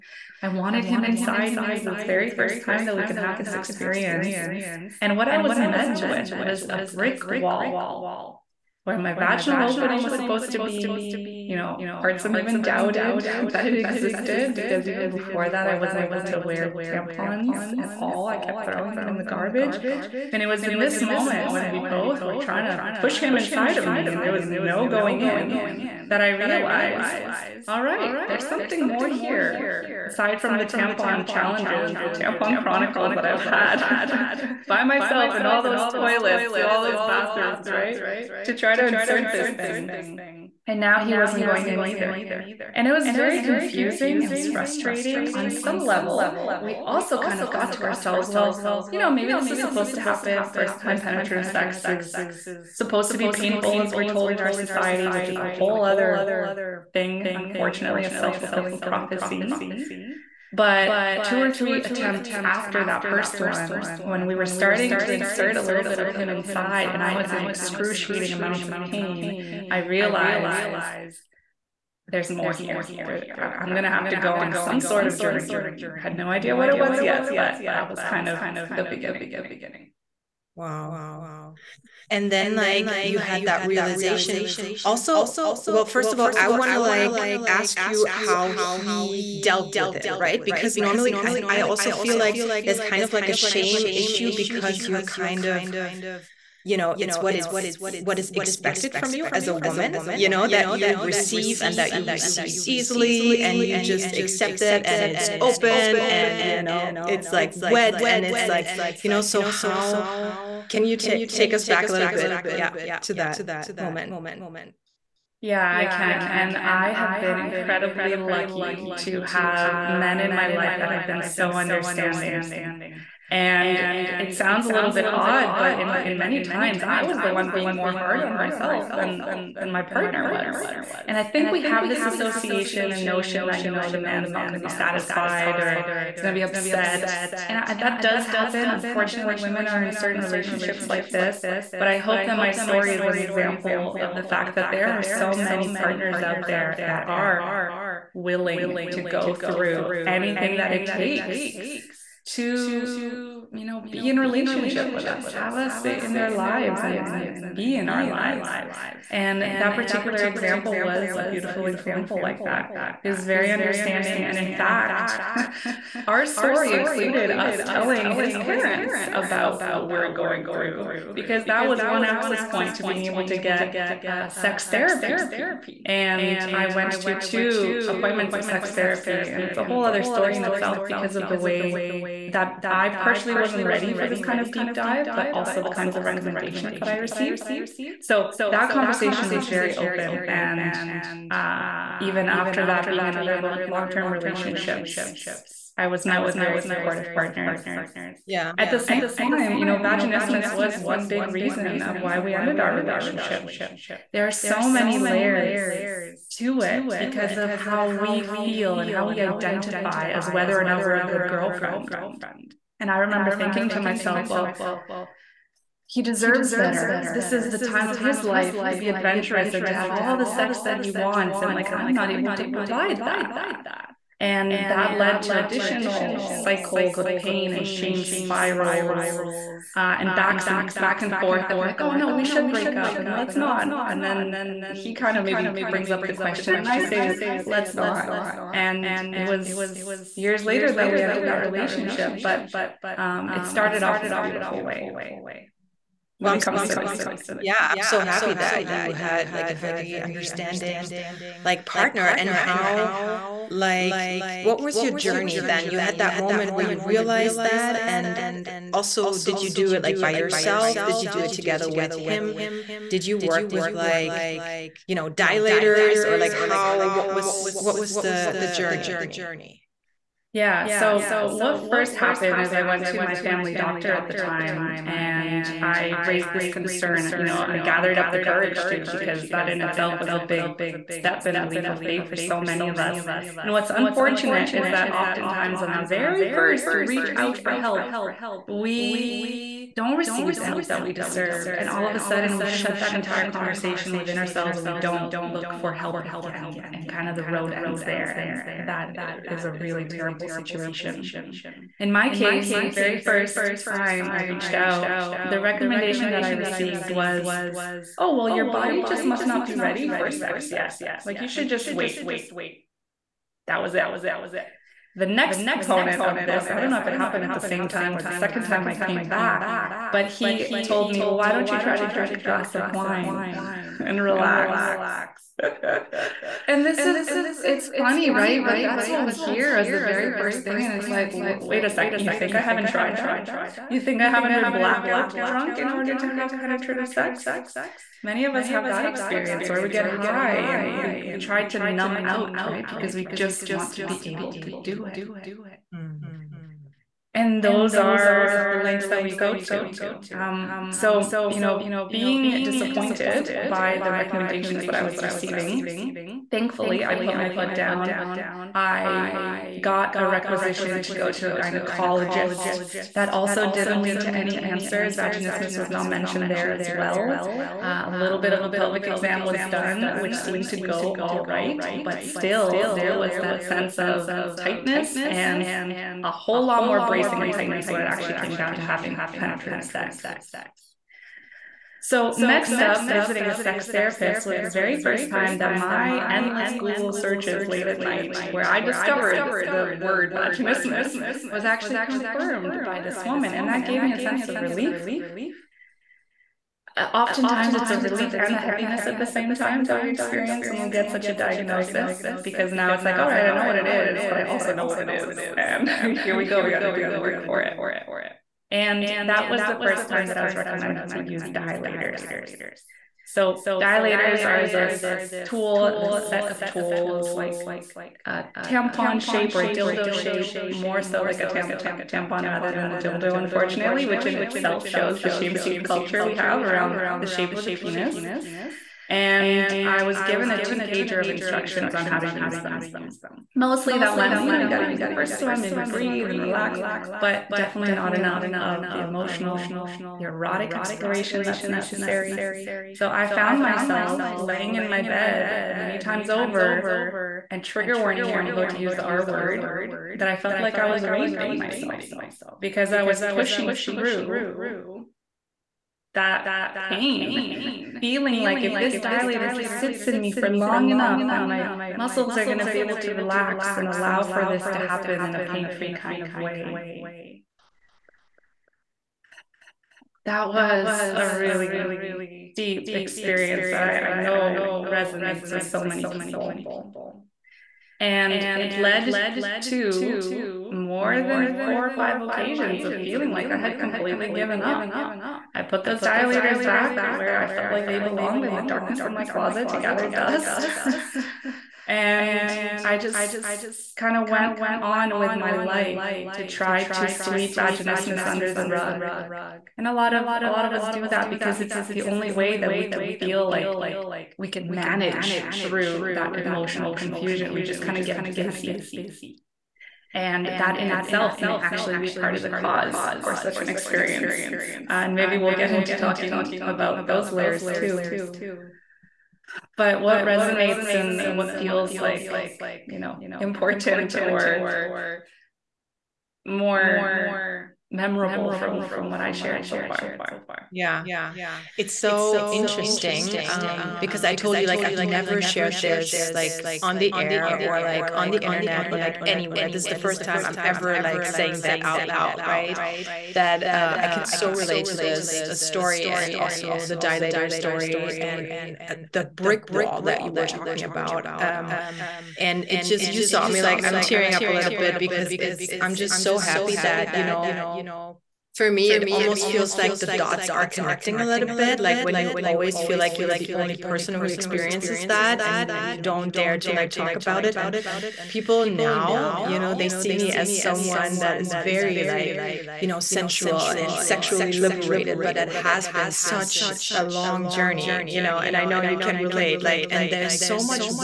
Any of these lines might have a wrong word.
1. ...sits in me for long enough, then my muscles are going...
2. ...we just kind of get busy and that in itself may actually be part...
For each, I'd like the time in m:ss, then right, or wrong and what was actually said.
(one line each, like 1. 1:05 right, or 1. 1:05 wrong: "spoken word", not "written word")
1. 7:39 right
2. 8:27 right.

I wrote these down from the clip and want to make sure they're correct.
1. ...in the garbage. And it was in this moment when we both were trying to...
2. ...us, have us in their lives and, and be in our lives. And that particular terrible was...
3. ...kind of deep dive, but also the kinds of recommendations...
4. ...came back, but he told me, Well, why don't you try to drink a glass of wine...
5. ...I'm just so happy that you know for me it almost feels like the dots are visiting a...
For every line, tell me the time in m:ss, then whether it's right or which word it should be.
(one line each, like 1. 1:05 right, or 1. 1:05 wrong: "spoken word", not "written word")
1. 0:19 right
2. 2:35 wrong: "example", not "terrible"
3. 3:04 right
4. 5:18 right
5. 9:15 wrong: "connecting", not "visiting".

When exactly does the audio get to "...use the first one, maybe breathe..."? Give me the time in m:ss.
7:14.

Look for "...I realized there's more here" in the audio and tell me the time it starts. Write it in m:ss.
1:09.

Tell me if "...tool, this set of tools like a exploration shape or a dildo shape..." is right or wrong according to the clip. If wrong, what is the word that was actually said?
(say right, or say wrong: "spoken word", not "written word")
wrong: "tampon", not "exploration".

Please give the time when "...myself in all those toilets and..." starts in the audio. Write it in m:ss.
0:34.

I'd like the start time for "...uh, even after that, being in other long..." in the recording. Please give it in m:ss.
3:11.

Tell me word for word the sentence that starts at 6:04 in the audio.
Vaginismus was not mentioned there as well.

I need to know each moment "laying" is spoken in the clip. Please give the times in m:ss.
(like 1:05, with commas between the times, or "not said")
7:24.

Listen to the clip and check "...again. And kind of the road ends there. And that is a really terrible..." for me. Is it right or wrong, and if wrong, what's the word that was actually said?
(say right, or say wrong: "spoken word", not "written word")
right.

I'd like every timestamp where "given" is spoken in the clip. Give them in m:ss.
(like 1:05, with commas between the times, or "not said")
7:10, 8:04.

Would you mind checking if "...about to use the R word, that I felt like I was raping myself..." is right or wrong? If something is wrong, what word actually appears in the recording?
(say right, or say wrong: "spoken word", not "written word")
right.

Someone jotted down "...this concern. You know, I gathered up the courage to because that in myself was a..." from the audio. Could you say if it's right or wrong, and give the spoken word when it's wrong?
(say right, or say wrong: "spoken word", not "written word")
wrong: "itself", not "myself".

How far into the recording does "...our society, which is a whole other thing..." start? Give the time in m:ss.
0:54.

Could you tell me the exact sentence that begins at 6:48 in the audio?
And that was the first time that I was recommended to use dilators.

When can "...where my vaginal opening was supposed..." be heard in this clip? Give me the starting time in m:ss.
0:08.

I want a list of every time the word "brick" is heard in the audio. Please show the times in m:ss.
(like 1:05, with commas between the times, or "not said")
0:06, 9:09.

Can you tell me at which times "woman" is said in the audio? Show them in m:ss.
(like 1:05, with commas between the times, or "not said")
1:39, 6:33.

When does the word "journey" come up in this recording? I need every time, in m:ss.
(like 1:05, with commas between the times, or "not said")
1:15, 4:14, 4:28, 9:37.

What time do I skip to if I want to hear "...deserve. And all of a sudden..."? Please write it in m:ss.
4:50.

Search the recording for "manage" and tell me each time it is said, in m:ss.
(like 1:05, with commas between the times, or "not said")
8:24.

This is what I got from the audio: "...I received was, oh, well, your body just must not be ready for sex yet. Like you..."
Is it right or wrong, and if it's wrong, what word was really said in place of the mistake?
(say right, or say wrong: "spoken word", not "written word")
right.